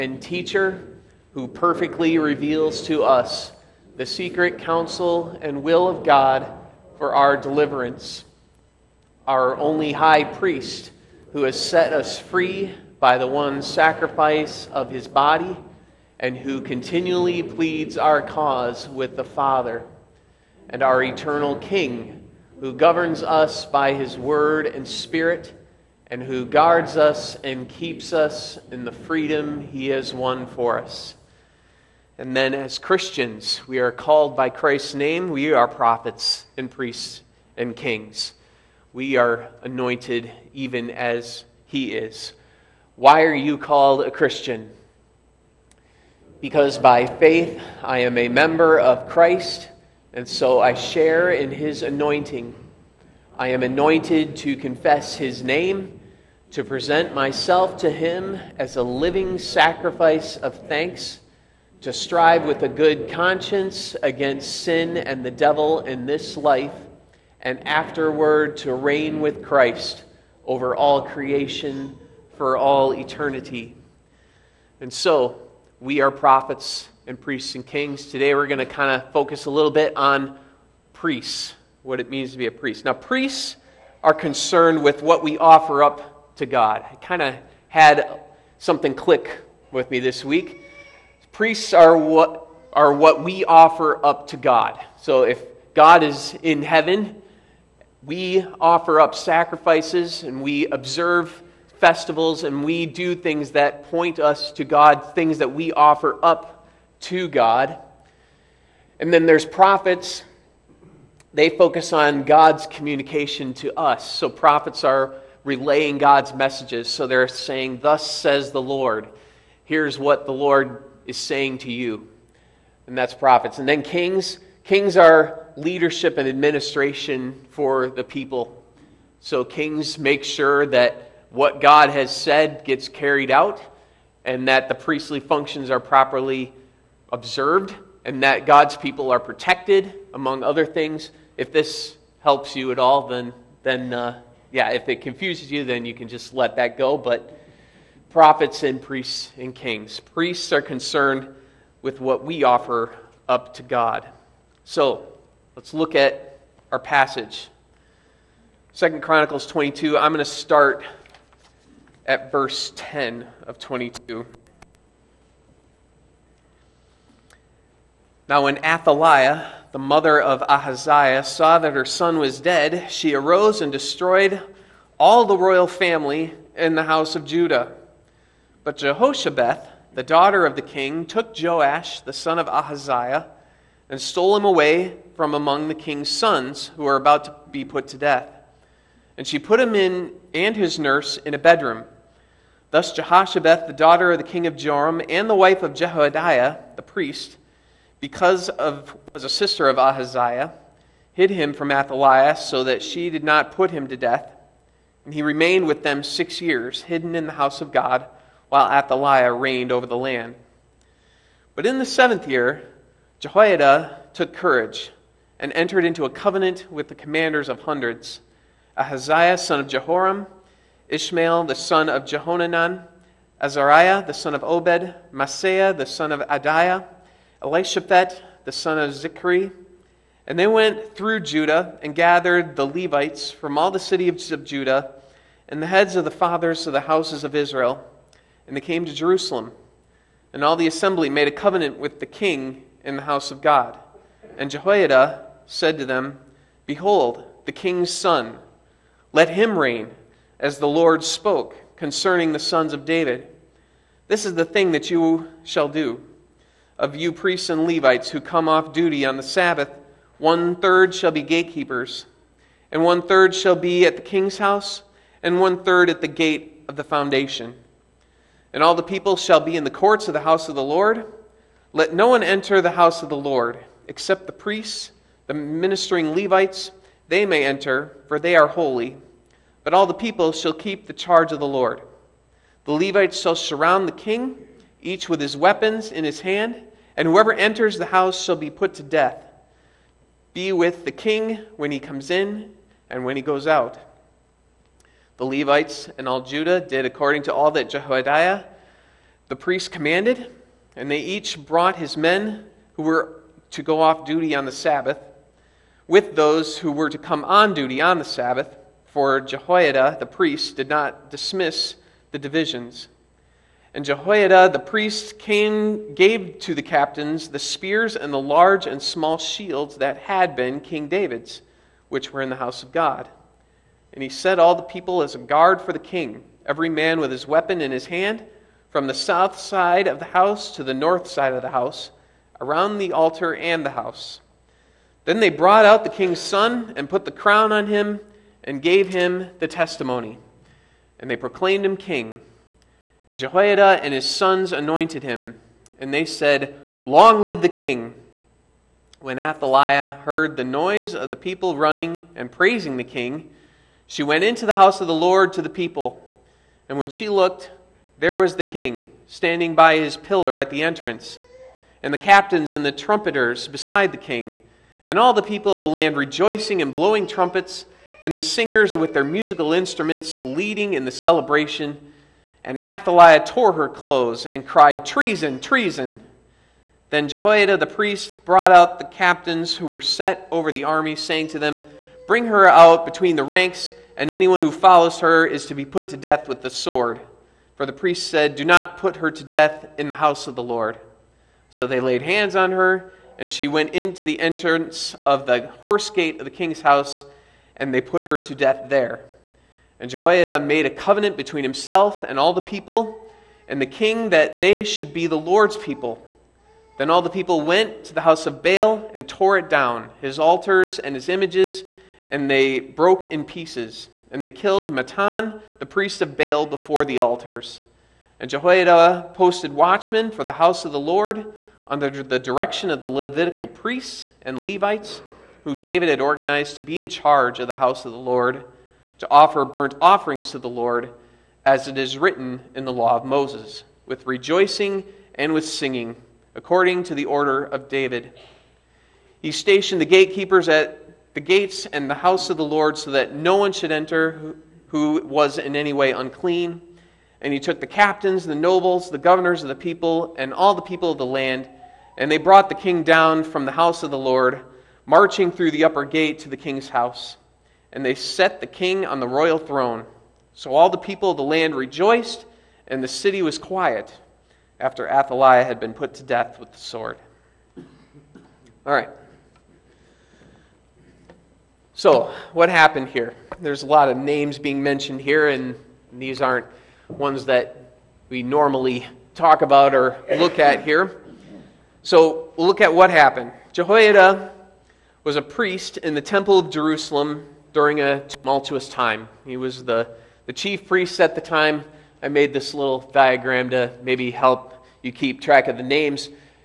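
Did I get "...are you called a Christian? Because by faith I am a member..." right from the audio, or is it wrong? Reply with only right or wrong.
right.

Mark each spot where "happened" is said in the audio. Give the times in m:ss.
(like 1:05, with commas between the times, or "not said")
7:52, 8:02.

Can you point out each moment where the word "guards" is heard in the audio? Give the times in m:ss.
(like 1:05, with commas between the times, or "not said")
0:26, 5:25.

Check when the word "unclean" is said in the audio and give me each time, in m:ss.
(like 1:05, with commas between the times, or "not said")
7:25.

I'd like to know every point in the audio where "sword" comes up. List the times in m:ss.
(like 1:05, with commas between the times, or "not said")
6:26, 7:46.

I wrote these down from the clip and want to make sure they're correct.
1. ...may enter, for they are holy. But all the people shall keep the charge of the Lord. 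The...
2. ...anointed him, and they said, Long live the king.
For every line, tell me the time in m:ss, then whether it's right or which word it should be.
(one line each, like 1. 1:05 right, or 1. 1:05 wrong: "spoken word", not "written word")
1. 4:37 right
2. 5:44 right.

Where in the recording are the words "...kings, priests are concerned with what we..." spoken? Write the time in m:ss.
2:29.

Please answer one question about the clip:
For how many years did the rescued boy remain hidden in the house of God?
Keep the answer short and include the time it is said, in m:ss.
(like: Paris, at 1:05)
6, at 3:26.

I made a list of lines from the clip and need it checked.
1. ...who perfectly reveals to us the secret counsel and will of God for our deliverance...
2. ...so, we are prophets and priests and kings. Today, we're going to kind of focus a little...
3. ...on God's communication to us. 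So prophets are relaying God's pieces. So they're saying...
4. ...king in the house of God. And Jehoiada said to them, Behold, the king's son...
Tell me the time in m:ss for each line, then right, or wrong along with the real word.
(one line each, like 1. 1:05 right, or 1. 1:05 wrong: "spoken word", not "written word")
1. 0:01 right
2. 1:14 right
3. 1:51 wrong: "messages", not "pieces"
4. 4:02 right.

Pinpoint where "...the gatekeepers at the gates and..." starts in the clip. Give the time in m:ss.
7:19.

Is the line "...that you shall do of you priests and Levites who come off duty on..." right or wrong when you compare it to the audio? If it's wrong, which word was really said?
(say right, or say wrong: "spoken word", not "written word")
right.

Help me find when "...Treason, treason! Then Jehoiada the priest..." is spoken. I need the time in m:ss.
6:14.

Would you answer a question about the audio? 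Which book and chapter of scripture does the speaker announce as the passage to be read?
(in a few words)
2 Chronicles 22.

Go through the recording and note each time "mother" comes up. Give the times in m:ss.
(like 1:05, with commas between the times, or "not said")
2:49.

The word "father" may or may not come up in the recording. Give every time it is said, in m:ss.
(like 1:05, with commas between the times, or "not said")
0:19, 3:56.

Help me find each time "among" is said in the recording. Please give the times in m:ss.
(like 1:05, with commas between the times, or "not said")
2:20, 3:05.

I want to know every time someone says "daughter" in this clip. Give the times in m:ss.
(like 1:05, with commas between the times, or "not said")
3:00, 3:13.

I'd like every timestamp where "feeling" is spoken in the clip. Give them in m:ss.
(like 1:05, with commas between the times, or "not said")
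not said.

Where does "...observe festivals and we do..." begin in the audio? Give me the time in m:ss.
1:40.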